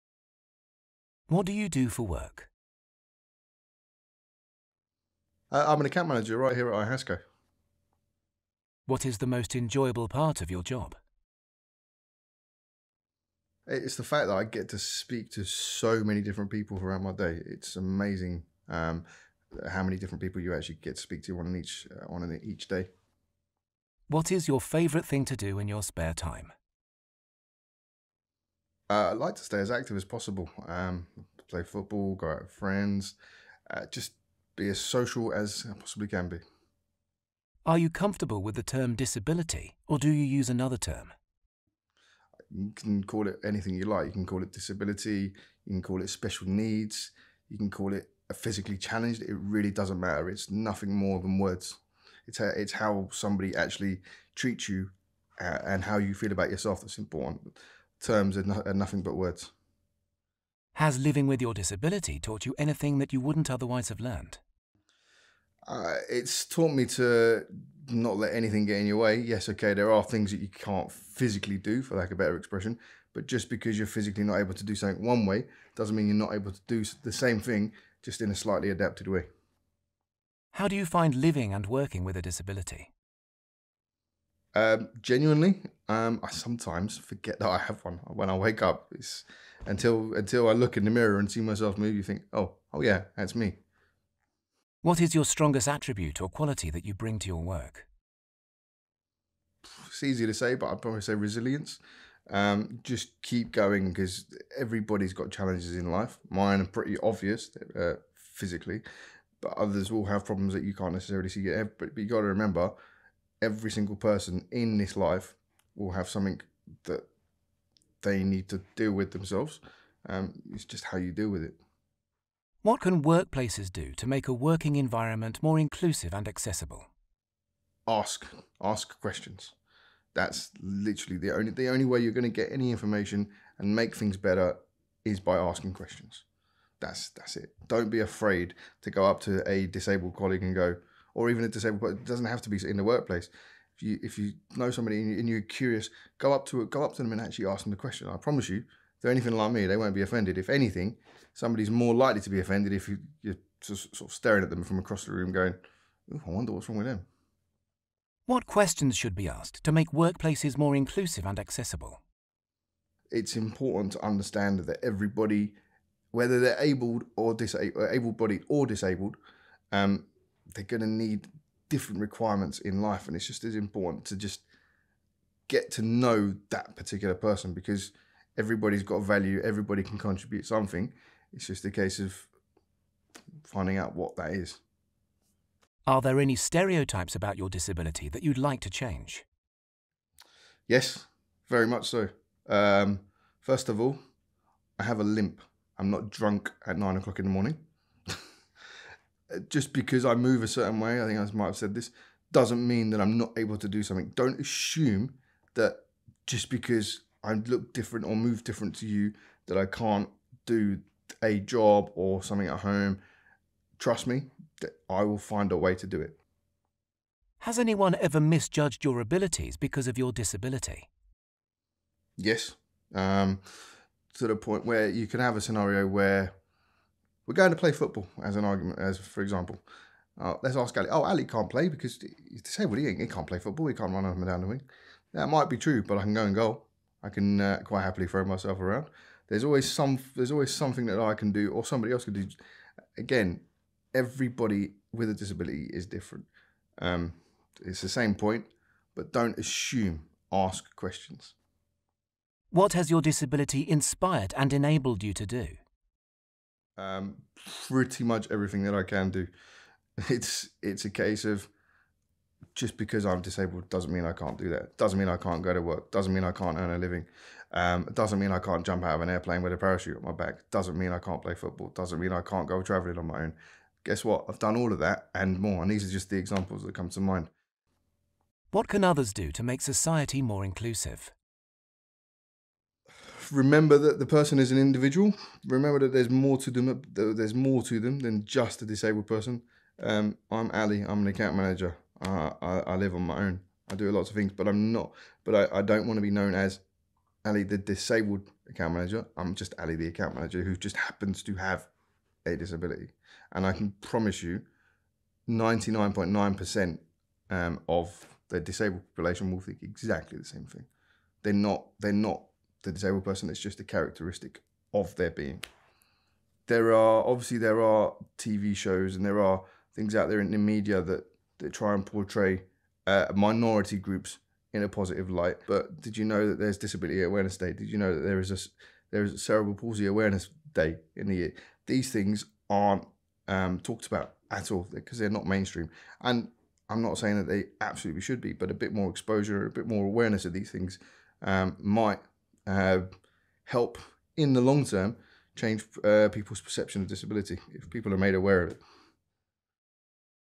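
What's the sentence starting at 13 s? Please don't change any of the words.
It's the fact that I get to speak to so many different people throughout my day.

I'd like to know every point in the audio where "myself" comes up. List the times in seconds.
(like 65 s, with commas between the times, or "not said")
91 s, 238 s.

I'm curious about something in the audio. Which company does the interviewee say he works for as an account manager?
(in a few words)
IHASCO.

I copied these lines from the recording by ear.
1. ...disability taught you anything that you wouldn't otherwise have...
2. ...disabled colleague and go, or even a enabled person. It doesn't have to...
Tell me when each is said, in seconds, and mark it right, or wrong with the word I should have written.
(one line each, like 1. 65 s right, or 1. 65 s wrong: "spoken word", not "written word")
1. 61 s right
2. 139 s wrong: "disabled", not "enabled".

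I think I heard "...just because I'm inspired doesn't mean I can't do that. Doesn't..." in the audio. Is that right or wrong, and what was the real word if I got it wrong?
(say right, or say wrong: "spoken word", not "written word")
wrong: "disabled", not "inspired".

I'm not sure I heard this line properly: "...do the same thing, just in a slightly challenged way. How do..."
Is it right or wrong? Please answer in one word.
wrong.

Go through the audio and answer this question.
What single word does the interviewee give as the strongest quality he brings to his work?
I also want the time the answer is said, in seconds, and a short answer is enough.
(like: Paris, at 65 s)
resilience, at 101 s.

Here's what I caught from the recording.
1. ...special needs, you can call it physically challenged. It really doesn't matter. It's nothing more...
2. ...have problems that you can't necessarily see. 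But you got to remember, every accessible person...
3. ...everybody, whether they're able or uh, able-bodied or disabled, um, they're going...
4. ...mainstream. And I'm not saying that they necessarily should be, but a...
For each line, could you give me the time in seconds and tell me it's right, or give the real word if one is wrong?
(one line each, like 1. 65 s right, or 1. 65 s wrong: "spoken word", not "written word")
1. 46 s right
2. 110 s wrong: "single", not "accessible"
3. 164 s right
4. 335 s wrong: "absolutely", not "necessarily".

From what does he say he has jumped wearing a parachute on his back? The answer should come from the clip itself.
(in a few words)
An airplane.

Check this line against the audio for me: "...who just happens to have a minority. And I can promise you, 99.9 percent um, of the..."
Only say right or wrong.
wrong.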